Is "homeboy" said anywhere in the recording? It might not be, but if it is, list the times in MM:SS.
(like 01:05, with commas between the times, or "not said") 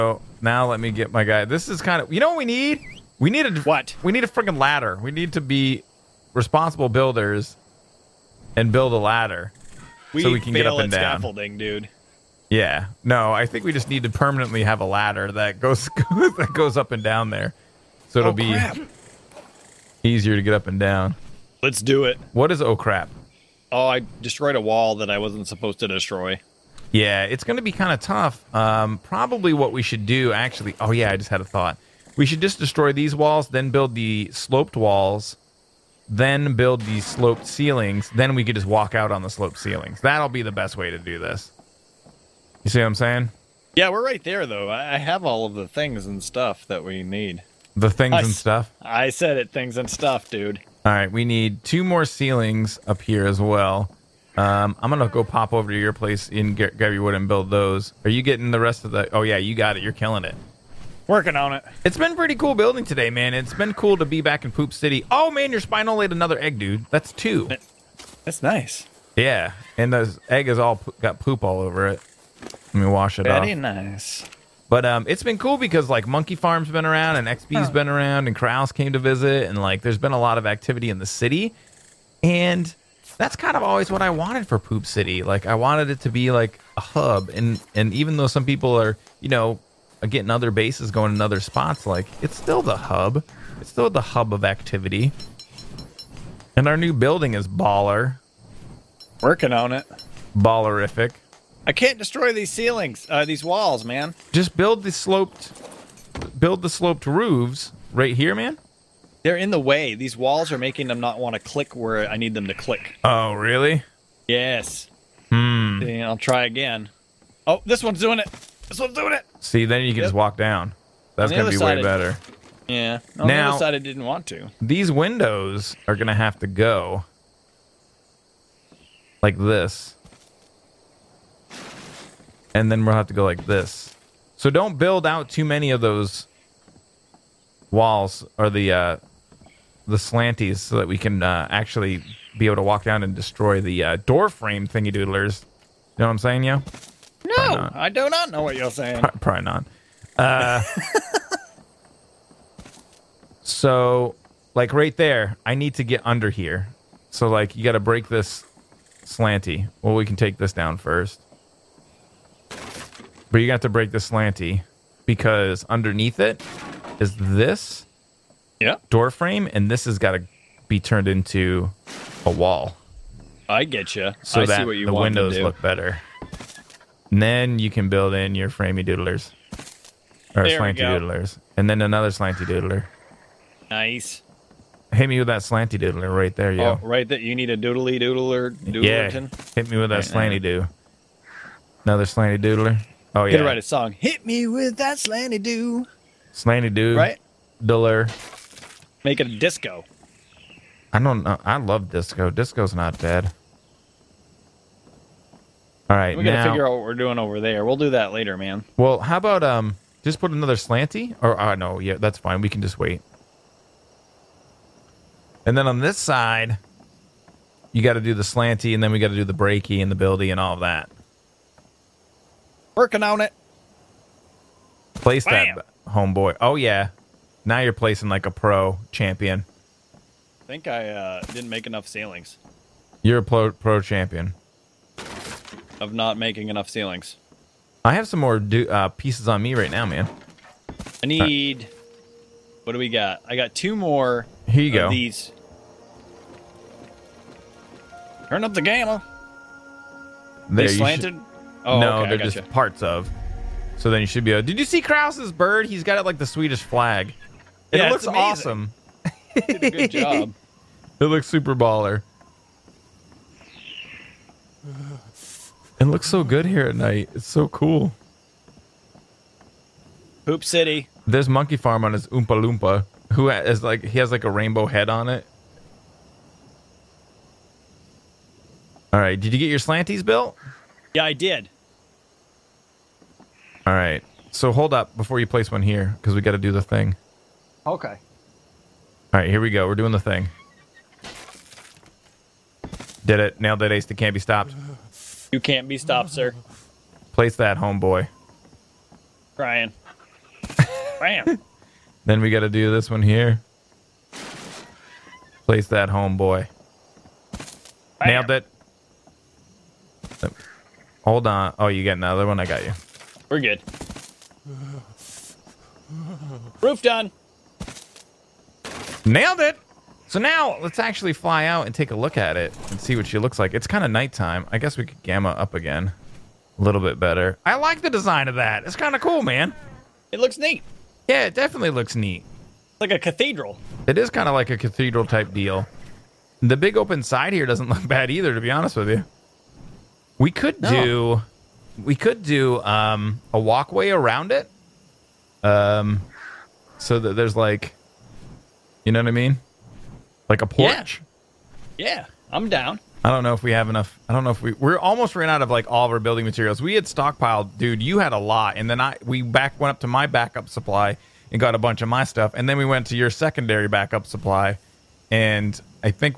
03:45, 04:57, 05:05.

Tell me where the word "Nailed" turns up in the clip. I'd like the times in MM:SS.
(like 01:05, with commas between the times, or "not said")
04:53, 05:08, 05:19.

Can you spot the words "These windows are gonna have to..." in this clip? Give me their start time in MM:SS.
02:04.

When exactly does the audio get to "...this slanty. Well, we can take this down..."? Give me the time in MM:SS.
02:38.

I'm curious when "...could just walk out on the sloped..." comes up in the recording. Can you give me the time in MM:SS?
00:38.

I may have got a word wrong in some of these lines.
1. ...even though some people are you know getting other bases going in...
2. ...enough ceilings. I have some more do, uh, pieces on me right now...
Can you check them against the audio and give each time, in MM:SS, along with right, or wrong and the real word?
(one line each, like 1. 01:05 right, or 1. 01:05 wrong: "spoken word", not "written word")
1. 01:27 right
2. 03:56 right.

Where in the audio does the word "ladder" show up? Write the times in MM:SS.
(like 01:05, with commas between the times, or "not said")
00:04, 00:08, 00:14.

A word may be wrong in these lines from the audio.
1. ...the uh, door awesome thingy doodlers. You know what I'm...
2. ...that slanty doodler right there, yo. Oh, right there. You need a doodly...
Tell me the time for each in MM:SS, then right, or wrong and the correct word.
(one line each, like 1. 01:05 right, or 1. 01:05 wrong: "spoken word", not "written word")
1. 02:23 wrong: "frame", not "awesome"
2. 03:05 right.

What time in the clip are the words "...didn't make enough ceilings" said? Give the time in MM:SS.
03:51.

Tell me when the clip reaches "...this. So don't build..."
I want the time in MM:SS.
02:13.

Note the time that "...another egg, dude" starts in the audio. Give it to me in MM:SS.
01:06.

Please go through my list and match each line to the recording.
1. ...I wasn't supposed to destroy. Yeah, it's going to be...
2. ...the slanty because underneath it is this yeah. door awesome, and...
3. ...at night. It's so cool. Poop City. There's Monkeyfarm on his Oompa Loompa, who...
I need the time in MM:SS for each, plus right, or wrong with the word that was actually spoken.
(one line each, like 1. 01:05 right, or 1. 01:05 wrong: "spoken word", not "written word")
1. 00:25 right
2. 02:43 wrong: "frame", not "awesome"
3. 04:26 right.